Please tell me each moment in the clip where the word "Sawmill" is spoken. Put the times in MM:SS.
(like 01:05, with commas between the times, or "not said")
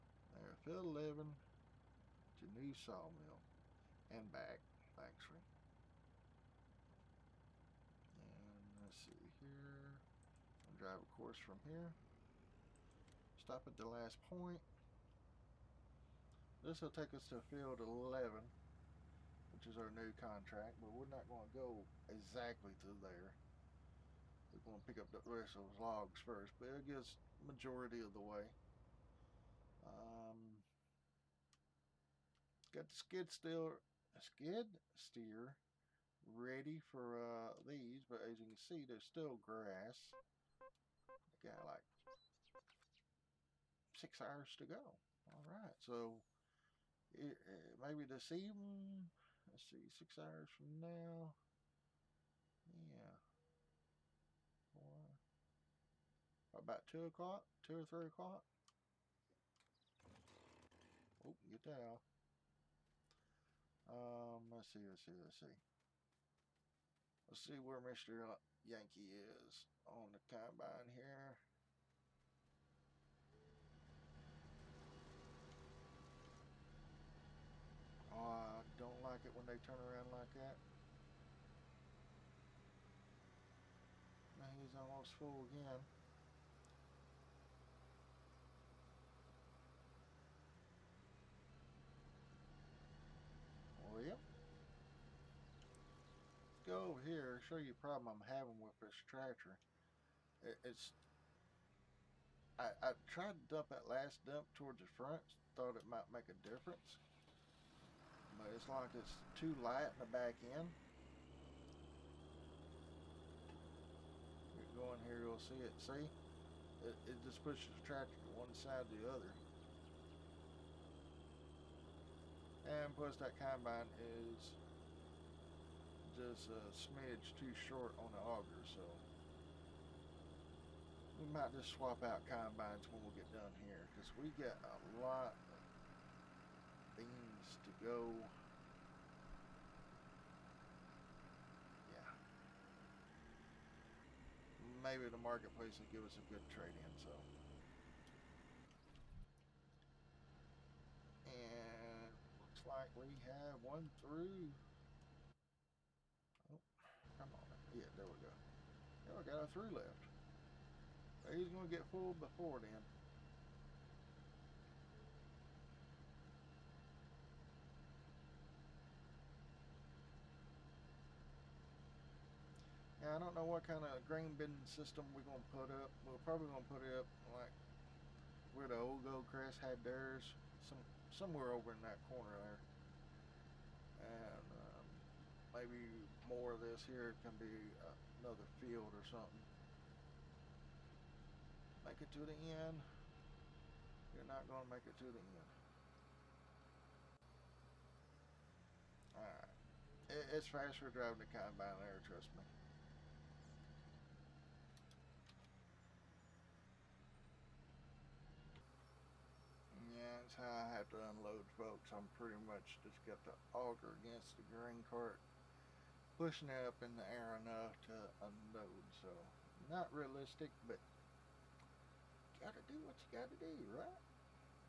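00:02.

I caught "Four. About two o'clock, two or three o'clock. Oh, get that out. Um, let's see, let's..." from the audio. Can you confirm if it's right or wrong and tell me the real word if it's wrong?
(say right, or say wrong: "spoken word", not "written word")
right.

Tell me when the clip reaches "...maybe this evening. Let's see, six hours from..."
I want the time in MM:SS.
00:47.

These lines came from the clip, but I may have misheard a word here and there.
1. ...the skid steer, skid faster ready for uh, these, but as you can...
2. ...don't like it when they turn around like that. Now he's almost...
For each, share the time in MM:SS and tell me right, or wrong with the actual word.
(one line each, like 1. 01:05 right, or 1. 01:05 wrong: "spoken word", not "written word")
1. 00:32 wrong: "steer", not "faster"
2. 01:18 right.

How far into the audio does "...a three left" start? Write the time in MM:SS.
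02:39.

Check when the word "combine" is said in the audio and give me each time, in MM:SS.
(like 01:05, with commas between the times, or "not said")
01:10, 02:03, 02:12, 03:21.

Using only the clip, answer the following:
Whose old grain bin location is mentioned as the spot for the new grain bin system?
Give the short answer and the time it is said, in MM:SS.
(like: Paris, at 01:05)
Goldcrest, at 02:59.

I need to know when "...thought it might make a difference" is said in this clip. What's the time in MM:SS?
01:45.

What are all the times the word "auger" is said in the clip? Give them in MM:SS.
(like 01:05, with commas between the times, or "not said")
02:08, 03:33.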